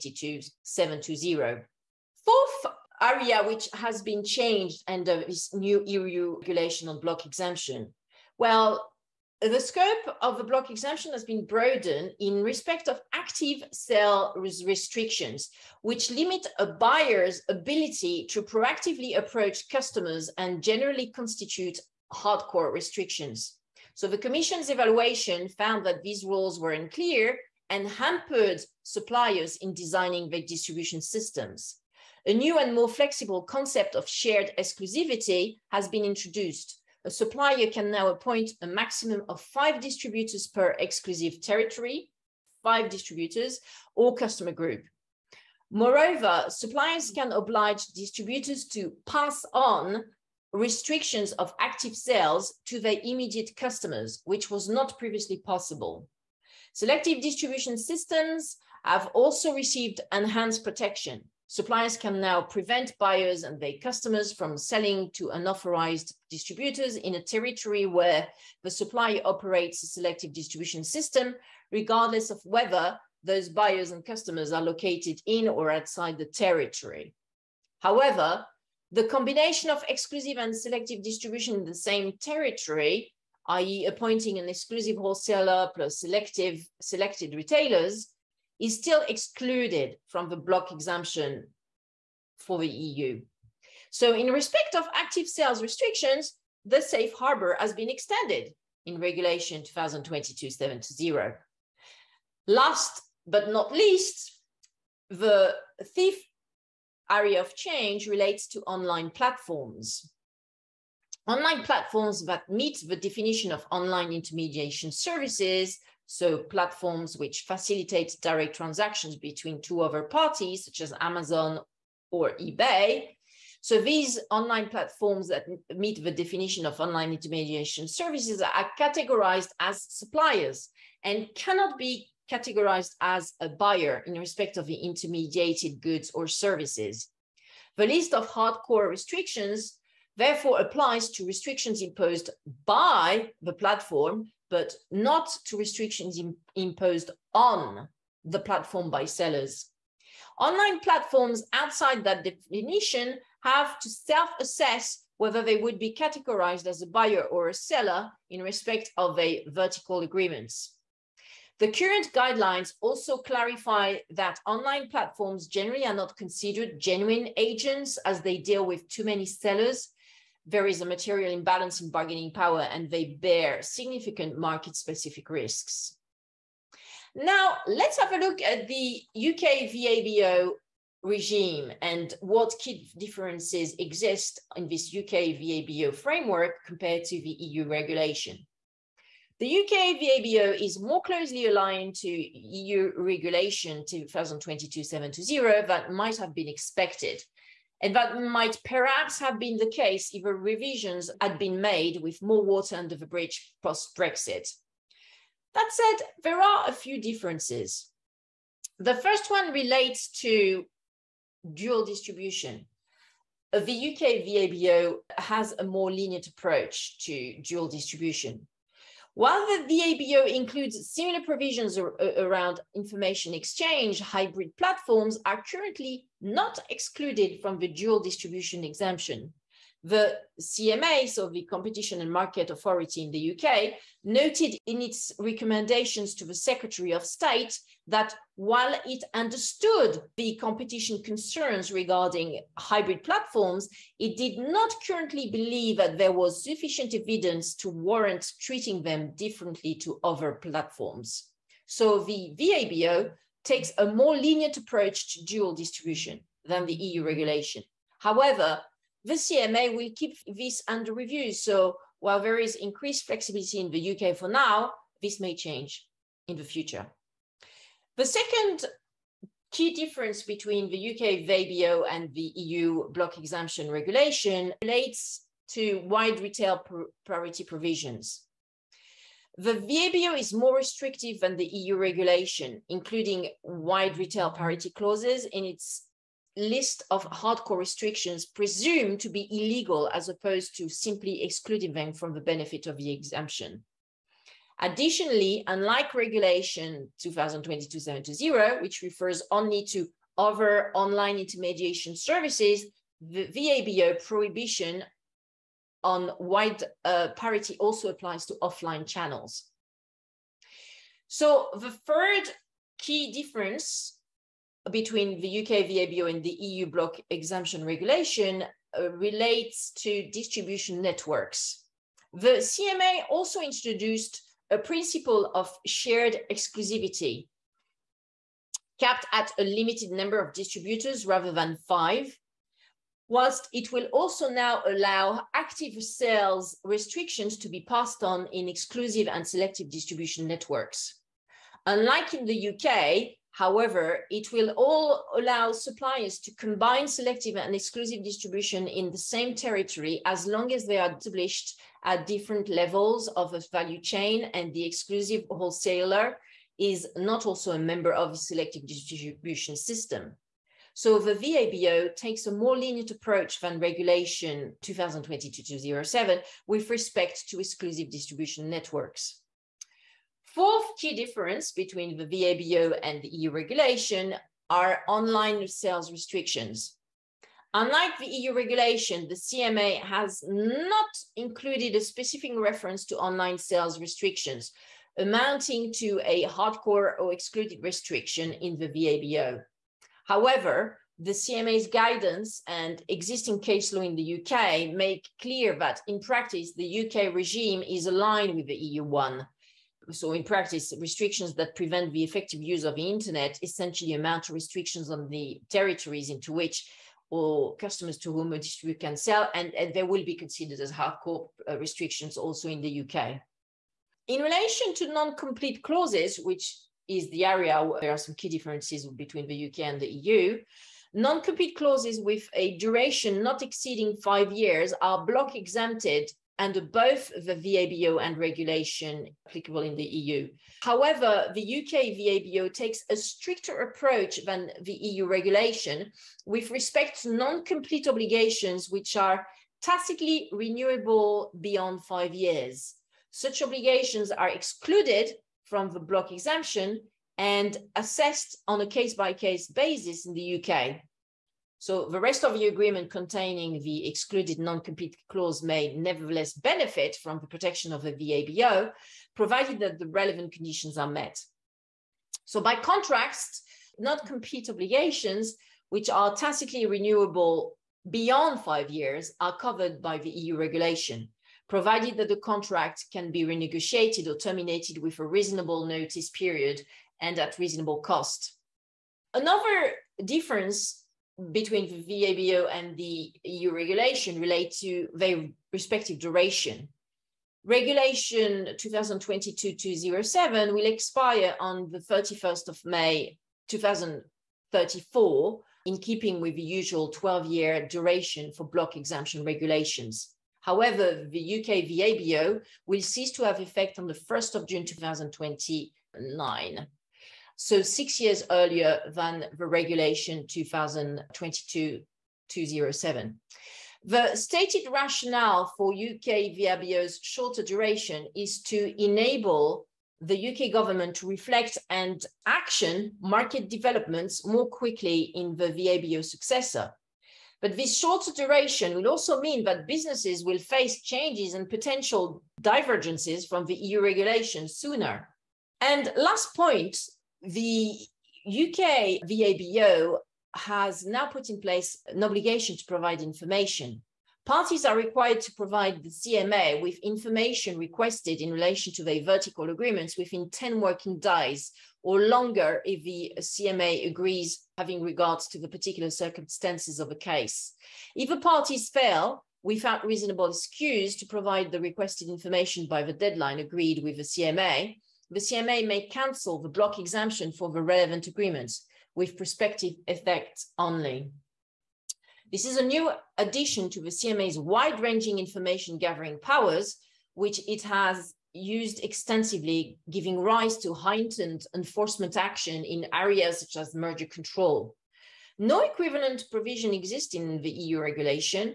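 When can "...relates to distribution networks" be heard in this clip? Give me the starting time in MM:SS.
05:18.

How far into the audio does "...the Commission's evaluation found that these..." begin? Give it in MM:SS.
00:24.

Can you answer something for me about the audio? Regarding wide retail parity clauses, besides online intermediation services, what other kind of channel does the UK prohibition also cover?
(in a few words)
offline channels.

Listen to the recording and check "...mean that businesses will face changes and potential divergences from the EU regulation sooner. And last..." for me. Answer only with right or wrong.
right.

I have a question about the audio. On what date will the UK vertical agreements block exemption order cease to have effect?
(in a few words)
1 June 2029.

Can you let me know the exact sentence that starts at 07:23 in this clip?
Such obligations are excluded from the block exemption and assessed on a case by case basis in the UK.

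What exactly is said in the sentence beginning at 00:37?
A supplier can now appoint a maximum of five distributors per exclusive territory, five distributors, or customer group.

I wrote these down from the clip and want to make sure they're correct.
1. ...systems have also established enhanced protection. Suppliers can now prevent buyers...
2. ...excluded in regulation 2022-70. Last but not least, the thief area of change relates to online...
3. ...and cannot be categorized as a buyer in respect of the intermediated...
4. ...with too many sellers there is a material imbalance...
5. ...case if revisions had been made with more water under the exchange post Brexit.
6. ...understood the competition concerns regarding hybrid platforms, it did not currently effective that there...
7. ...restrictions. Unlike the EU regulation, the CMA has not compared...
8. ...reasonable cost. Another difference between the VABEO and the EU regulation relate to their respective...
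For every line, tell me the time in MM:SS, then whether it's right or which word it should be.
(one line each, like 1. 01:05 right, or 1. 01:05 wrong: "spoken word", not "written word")
1. 00:57 wrong: "received", not "established"
2. 01:37 wrong: "extended", not "excluded"
3. 02:11 right
4. 02:48 right
5. 03:19 wrong: "bridge", not "exchange"
6. 03:59 wrong: "believe", not "effective"
7. 06:15 wrong: "included", not "compared"
8. 07:57 right.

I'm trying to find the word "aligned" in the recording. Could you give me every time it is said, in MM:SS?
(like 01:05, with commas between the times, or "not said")
03:11, 06:37.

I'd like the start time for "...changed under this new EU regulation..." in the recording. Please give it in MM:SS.
00:04.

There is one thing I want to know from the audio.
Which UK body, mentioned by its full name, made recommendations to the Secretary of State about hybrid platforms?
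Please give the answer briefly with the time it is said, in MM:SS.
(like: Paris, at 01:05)
Competition and Market Authority, at 03:51.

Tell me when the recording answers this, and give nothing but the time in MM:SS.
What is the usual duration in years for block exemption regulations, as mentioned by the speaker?
08:16.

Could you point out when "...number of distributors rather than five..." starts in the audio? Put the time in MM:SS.
05:29.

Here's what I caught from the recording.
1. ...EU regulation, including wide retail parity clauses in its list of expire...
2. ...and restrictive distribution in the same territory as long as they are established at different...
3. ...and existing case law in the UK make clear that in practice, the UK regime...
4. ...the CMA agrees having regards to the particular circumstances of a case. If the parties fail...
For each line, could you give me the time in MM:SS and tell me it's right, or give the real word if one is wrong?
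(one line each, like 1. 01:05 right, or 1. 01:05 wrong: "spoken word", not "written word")
1. 04:41 wrong: "hardcore", not "expire"
2. 05:47 wrong: "exclusive", not "restrictive"
3. 06:32 right
4. 09:12 right.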